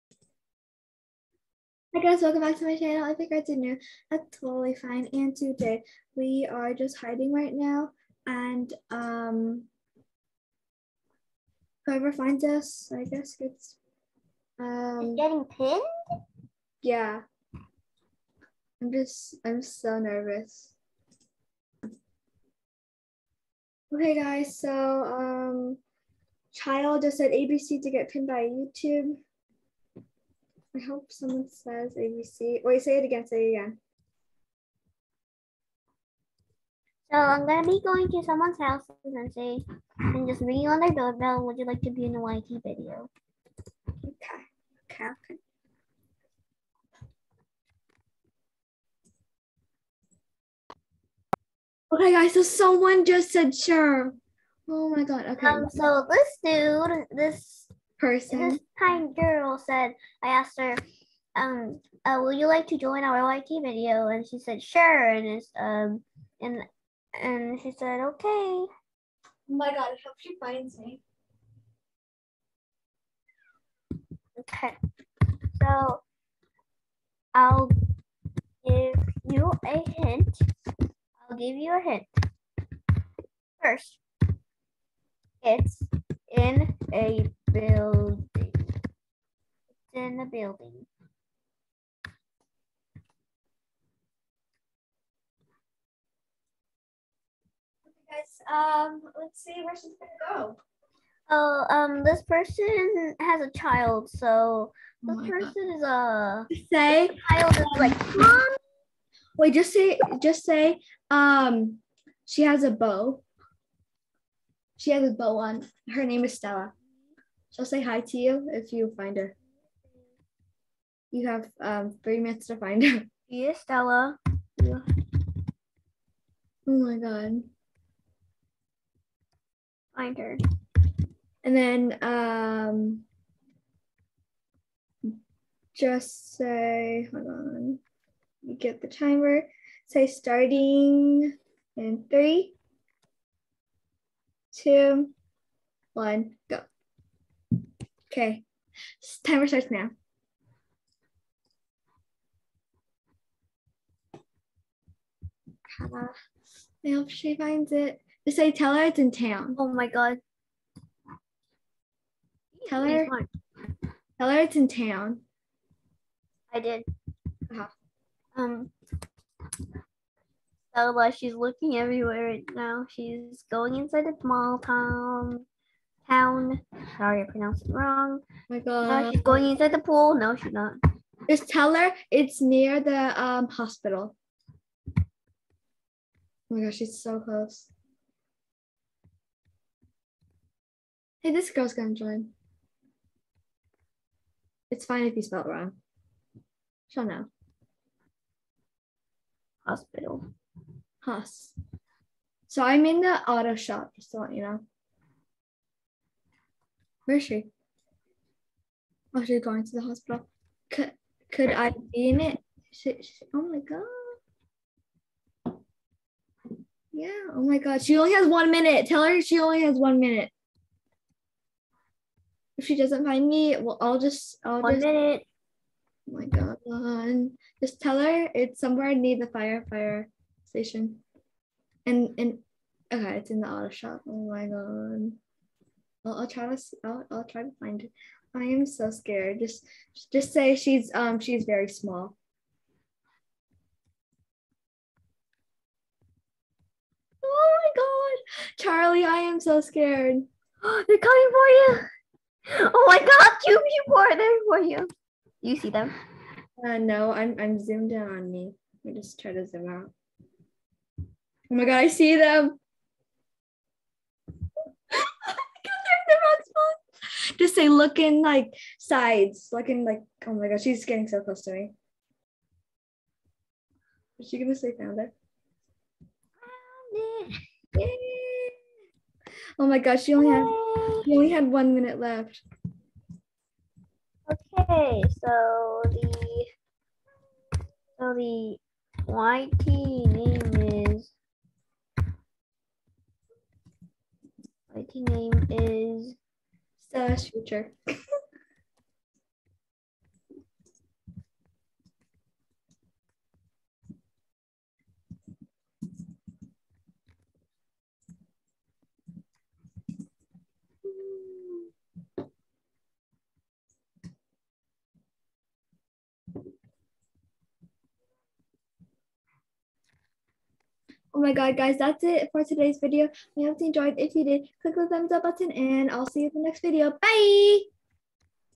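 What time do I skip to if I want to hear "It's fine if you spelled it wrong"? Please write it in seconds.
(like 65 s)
194 s.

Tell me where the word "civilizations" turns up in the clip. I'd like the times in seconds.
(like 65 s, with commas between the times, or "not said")
not said.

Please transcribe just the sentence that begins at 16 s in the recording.
Yeah, I'm just I'm so nervous.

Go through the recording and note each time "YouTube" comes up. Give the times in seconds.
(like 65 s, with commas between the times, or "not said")
28 s.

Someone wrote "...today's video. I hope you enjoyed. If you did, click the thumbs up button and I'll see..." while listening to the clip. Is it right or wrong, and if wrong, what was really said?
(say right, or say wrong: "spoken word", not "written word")
right.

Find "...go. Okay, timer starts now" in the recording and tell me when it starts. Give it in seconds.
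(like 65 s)
146 s.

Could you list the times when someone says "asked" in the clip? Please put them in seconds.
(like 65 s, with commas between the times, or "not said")
60 s.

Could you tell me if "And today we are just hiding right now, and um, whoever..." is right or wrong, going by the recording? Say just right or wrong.
right.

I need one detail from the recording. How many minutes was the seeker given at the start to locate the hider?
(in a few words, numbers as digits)
3.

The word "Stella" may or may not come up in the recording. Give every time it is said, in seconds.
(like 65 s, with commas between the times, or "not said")
116 s, 123 s.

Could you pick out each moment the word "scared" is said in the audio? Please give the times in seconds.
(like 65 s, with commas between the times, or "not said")
238 s, 249 s.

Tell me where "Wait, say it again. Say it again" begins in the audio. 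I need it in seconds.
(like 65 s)
32 s.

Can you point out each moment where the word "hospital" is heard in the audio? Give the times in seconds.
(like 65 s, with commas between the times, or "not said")
183 s, 199 s, 209 s.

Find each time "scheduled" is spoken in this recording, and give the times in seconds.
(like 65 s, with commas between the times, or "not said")
not said.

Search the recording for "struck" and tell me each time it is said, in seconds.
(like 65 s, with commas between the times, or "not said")
not said.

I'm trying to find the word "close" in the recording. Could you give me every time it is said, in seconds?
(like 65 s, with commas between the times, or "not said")
187 s, 271 s.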